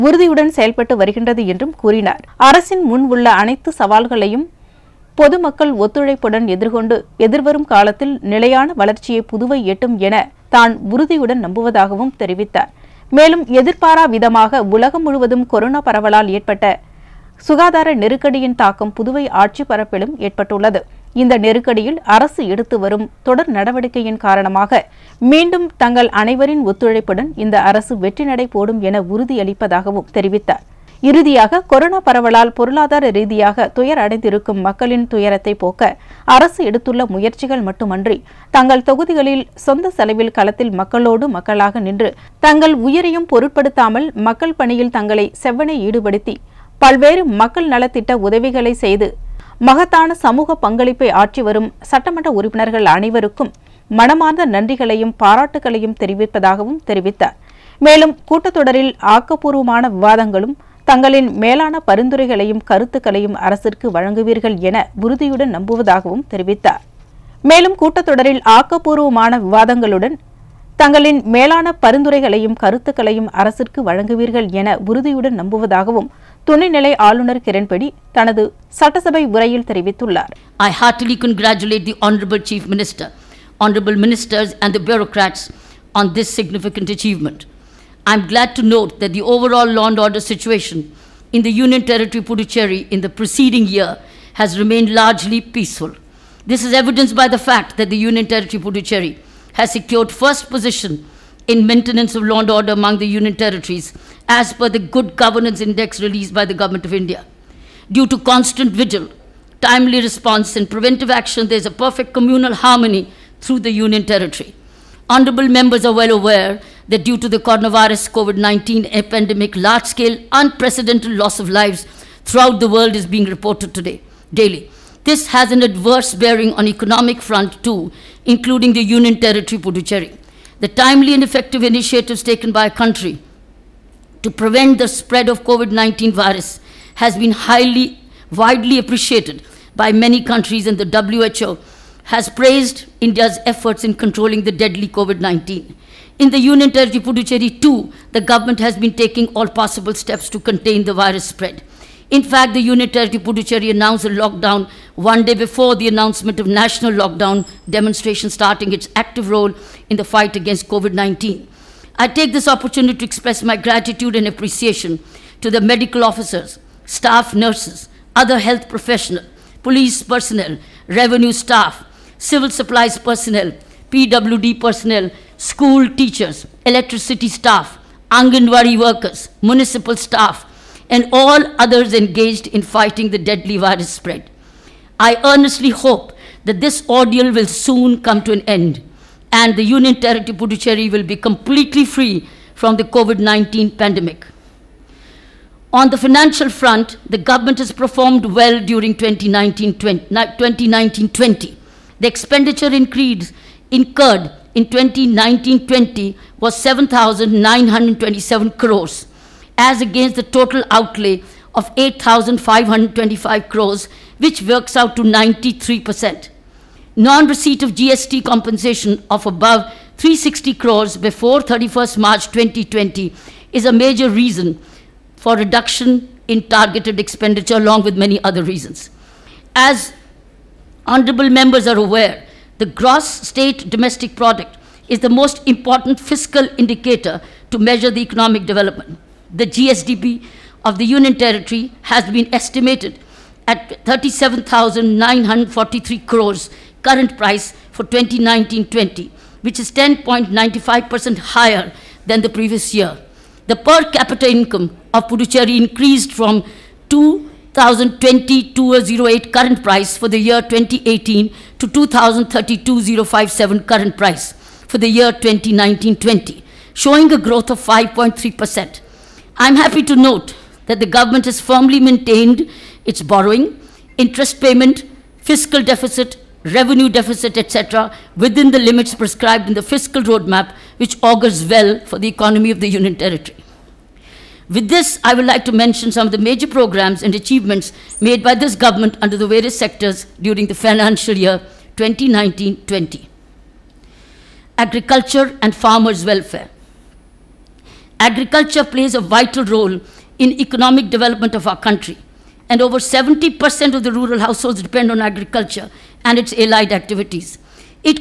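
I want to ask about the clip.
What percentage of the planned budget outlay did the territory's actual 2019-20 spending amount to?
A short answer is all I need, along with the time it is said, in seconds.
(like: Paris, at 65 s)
93%, at 215 s.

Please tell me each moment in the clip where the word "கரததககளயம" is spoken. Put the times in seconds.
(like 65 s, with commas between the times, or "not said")
62 s, 72 s.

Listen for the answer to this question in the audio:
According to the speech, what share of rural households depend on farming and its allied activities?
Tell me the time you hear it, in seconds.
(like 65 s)
302 s.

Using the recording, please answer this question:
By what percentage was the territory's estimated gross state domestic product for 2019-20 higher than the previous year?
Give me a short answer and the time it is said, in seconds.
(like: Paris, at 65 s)
10.95%, at 249 s.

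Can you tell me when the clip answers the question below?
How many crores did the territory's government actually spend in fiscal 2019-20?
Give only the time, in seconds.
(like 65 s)
206 s.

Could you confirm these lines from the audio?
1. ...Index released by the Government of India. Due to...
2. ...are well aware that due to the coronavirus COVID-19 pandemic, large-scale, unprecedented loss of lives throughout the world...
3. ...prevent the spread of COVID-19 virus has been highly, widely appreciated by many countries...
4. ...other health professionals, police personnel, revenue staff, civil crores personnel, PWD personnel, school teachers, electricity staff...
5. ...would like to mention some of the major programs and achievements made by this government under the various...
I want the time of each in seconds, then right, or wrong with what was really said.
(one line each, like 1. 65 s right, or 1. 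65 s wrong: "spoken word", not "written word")
1. 105 s right
2. 115 s right
3. 134 s right
4. 168 s wrong: "supplies", not "crores"
5. 285 s right.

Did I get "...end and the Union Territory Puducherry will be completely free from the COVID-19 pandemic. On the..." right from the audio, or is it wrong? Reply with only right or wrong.
right.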